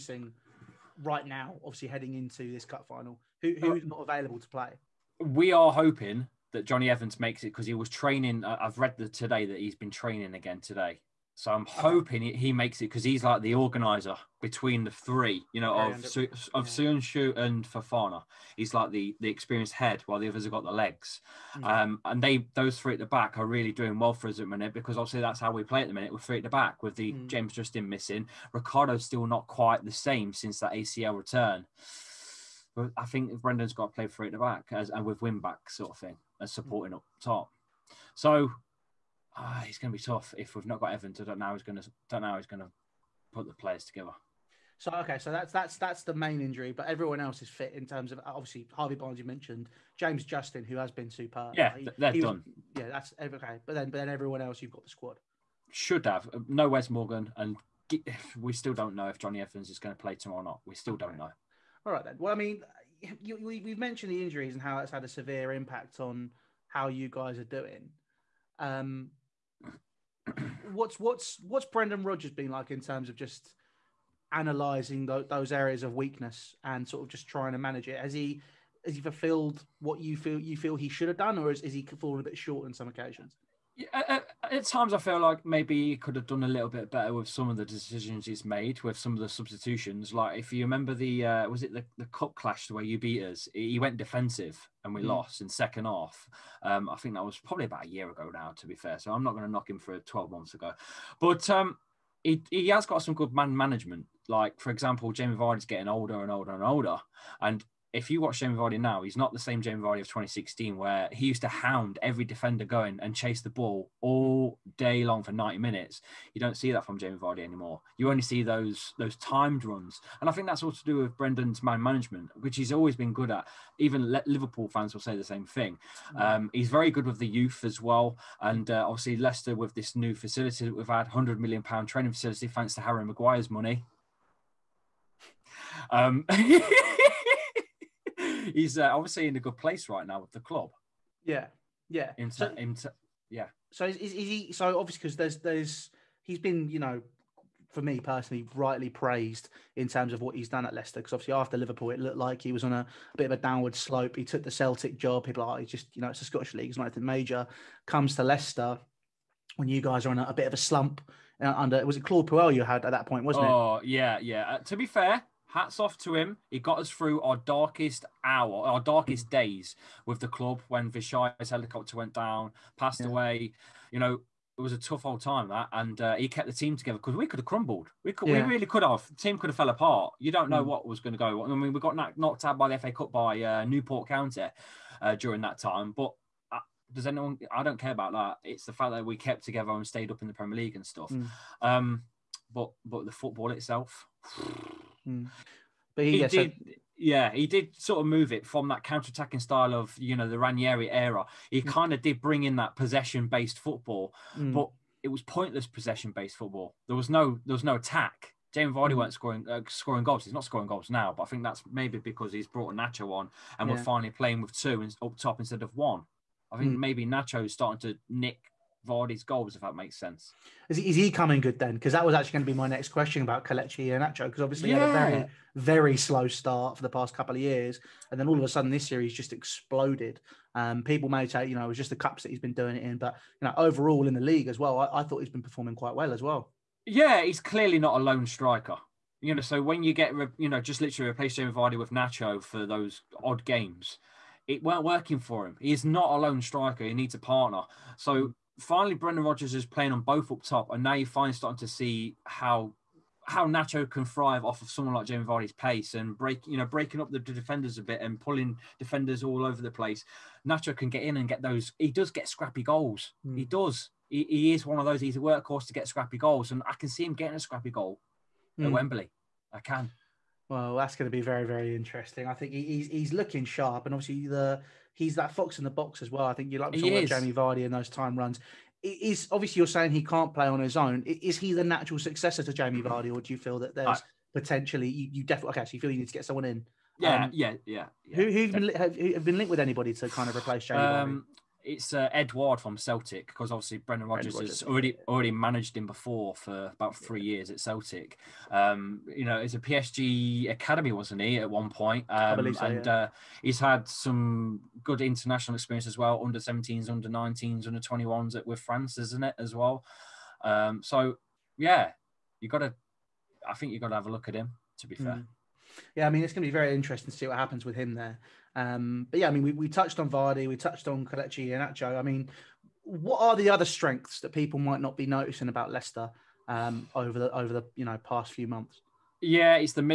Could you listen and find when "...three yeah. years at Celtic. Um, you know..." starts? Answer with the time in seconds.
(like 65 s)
296 s.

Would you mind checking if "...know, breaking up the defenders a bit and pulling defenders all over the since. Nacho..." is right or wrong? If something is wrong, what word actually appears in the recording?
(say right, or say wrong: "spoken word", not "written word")
wrong: "place", not "since".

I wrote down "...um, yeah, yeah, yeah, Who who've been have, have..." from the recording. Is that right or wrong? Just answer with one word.
right.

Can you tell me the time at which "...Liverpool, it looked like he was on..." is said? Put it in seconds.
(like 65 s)
151 s.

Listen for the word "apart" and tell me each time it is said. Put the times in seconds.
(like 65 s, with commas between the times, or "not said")
179 s.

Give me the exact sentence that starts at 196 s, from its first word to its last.
yeah, he did sort of move it from that counter-attacking style of you know the Ranieri era.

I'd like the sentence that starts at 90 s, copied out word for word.
Like if you remember the uh, was it the, the cup clash where you beat us, he went defensive and we mm.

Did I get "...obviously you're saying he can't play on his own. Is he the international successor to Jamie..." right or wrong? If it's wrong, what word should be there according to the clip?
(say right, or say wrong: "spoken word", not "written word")
wrong: "natural", not "international".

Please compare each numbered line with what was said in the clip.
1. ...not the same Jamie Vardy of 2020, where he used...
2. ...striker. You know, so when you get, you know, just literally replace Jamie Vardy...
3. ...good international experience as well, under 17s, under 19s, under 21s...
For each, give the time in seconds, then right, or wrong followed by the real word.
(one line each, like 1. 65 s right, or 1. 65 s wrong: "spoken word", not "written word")
1. 109 s wrong: "2016", not "2020"
2. 238 s right
3. 304 s right.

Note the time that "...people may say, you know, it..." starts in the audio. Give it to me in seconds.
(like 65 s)
230 s.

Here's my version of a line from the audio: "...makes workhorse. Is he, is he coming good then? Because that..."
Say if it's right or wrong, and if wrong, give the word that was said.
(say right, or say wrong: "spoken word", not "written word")
wrong: "sense", not "workhorse".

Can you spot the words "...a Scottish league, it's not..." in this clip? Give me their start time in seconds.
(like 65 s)
156 s.